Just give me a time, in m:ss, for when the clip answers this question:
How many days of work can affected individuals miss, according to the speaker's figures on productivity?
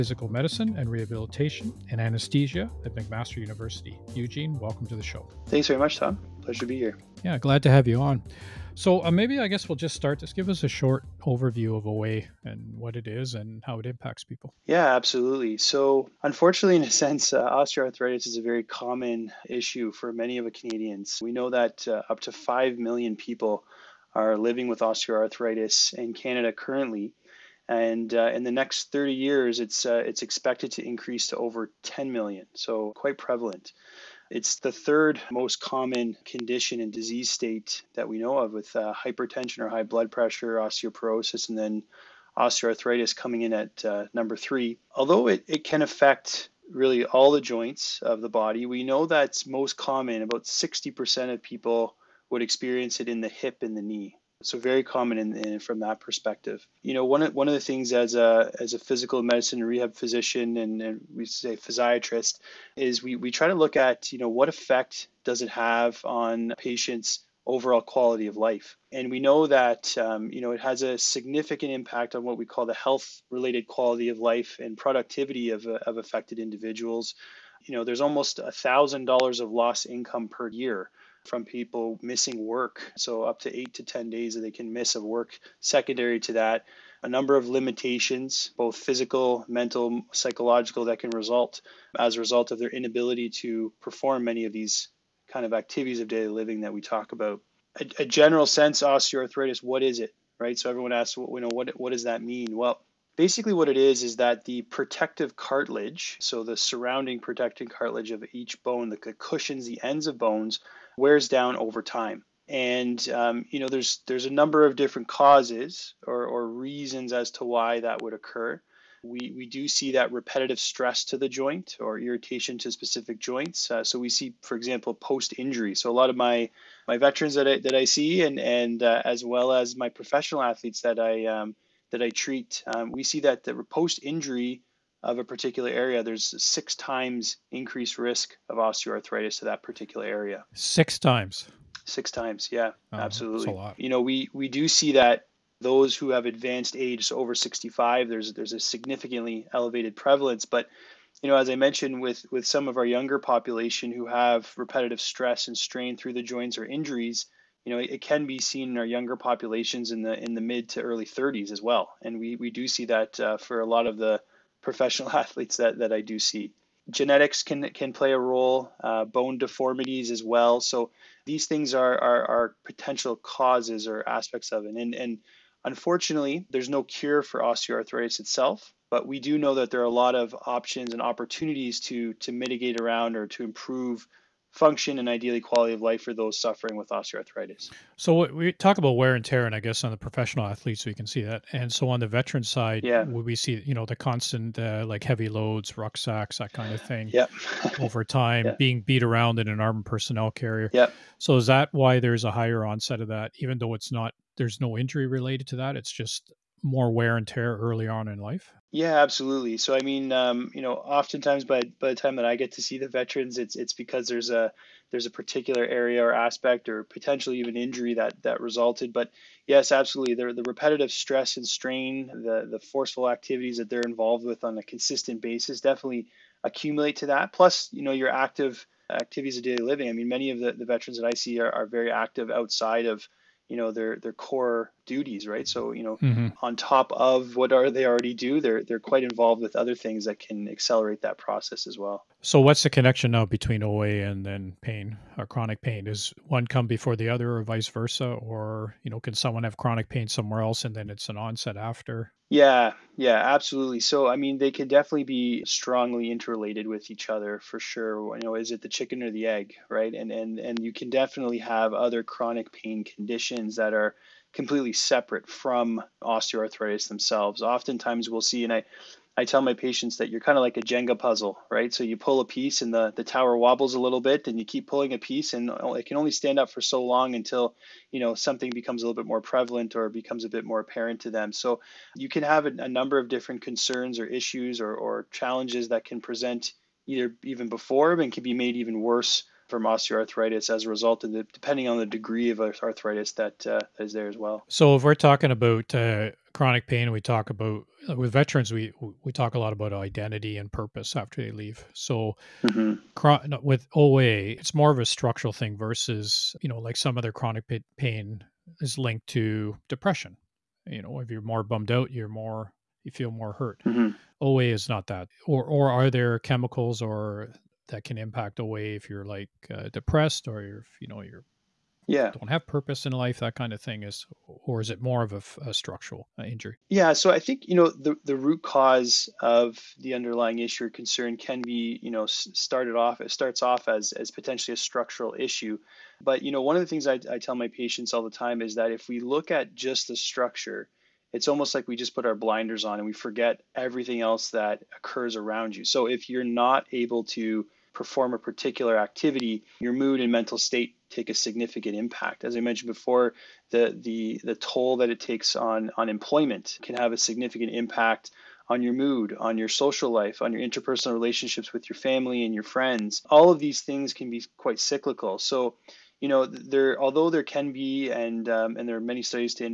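1:23.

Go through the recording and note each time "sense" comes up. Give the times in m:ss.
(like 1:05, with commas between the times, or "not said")
0:16, 1:38.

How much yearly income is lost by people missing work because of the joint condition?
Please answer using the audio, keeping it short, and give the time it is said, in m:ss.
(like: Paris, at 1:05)
$1,000, at 1:18.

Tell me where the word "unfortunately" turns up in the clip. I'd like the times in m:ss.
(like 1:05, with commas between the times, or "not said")
0:16, 2:55.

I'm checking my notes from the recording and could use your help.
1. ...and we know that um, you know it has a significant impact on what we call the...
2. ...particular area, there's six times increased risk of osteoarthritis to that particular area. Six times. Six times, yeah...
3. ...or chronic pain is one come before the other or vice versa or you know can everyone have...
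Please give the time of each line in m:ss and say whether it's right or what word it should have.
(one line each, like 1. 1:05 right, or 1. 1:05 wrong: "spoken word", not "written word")
1. 1:08 right
2. 2:15 right
3. 4:05 wrong: "someone", not "everyone".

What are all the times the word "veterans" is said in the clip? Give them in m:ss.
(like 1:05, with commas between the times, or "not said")
2:06, 3:12, 3:32, 3:50, 4:58.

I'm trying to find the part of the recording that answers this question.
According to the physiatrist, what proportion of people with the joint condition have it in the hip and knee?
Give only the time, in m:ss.
0:50.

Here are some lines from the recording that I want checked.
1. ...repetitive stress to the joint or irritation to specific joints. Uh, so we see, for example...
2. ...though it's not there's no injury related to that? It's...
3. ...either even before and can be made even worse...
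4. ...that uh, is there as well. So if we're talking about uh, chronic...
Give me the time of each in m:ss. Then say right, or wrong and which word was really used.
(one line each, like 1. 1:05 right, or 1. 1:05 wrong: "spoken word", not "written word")
1. 2:00 right
2. 3:23 right
3. 4:46 right
4. 4:53 right.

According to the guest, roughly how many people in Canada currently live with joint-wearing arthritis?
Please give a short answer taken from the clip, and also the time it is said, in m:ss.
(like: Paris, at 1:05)
5 million, at 0:22.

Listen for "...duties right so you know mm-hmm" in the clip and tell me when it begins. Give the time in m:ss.
3:54.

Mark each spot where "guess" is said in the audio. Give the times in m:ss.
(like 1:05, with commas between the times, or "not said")
0:09, 3:09.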